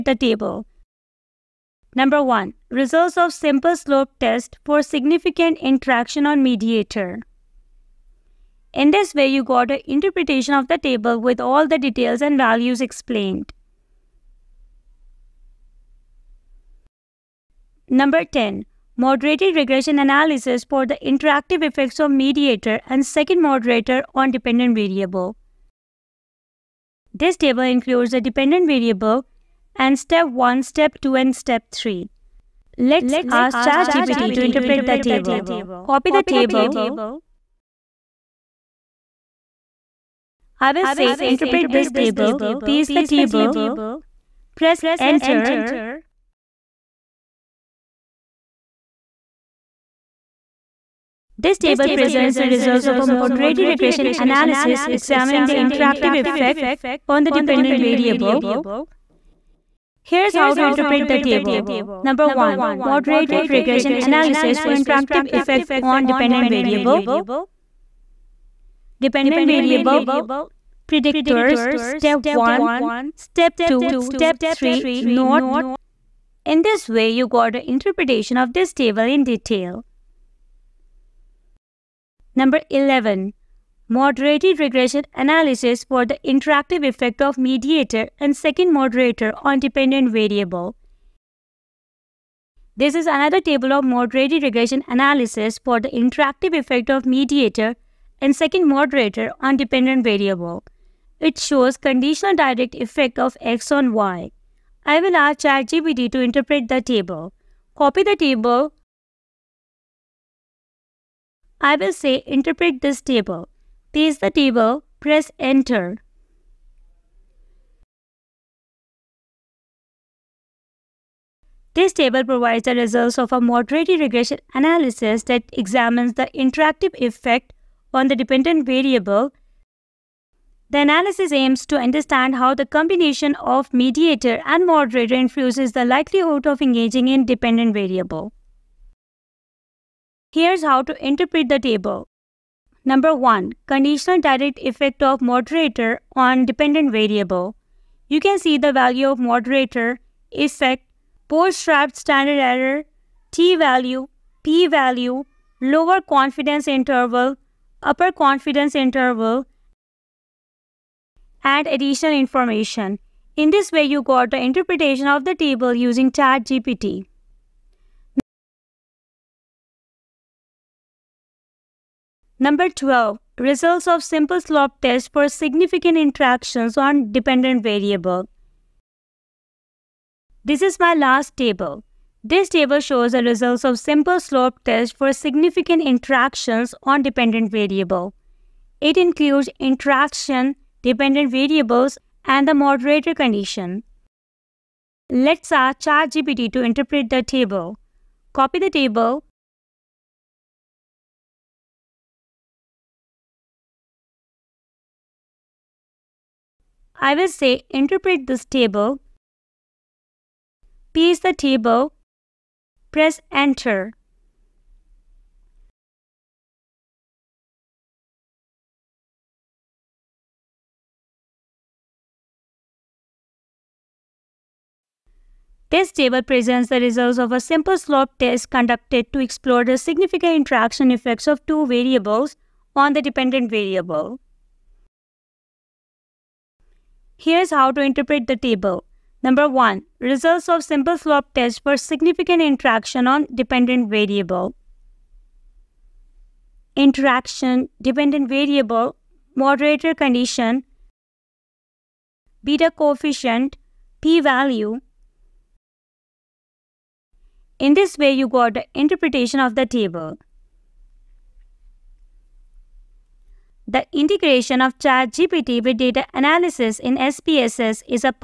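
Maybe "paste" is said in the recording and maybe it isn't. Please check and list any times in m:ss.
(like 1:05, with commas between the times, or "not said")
0:42, 1:53, 3:30.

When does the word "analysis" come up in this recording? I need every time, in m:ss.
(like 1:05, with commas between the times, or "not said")
0:19, 0:54, 1:03, 1:25, 1:34, 2:04, 2:10, 4:26.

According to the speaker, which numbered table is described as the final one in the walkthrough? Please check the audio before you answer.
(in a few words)
12.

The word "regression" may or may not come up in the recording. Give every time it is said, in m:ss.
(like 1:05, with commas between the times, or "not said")
0:19, 0:53, 1:03, 1:24, 1:34, 2:03.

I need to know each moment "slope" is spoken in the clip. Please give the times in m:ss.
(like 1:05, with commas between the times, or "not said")
0:03, 2:54, 3:04, 3:47, 4:00.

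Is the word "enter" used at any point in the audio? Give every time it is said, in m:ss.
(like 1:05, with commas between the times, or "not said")
0:45, 1:55, 3:33.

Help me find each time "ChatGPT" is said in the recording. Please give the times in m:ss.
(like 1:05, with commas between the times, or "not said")
0:33, 1:45, 2:46, 3:15, 4:24.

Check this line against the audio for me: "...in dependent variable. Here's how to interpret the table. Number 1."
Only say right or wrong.
right.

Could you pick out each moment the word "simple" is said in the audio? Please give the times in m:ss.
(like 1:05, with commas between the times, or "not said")
0:03, 2:54, 3:03, 3:47, 4:00.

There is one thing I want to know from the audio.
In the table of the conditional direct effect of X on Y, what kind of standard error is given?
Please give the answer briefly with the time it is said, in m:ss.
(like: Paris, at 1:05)
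Bootstrapped, at 2:31.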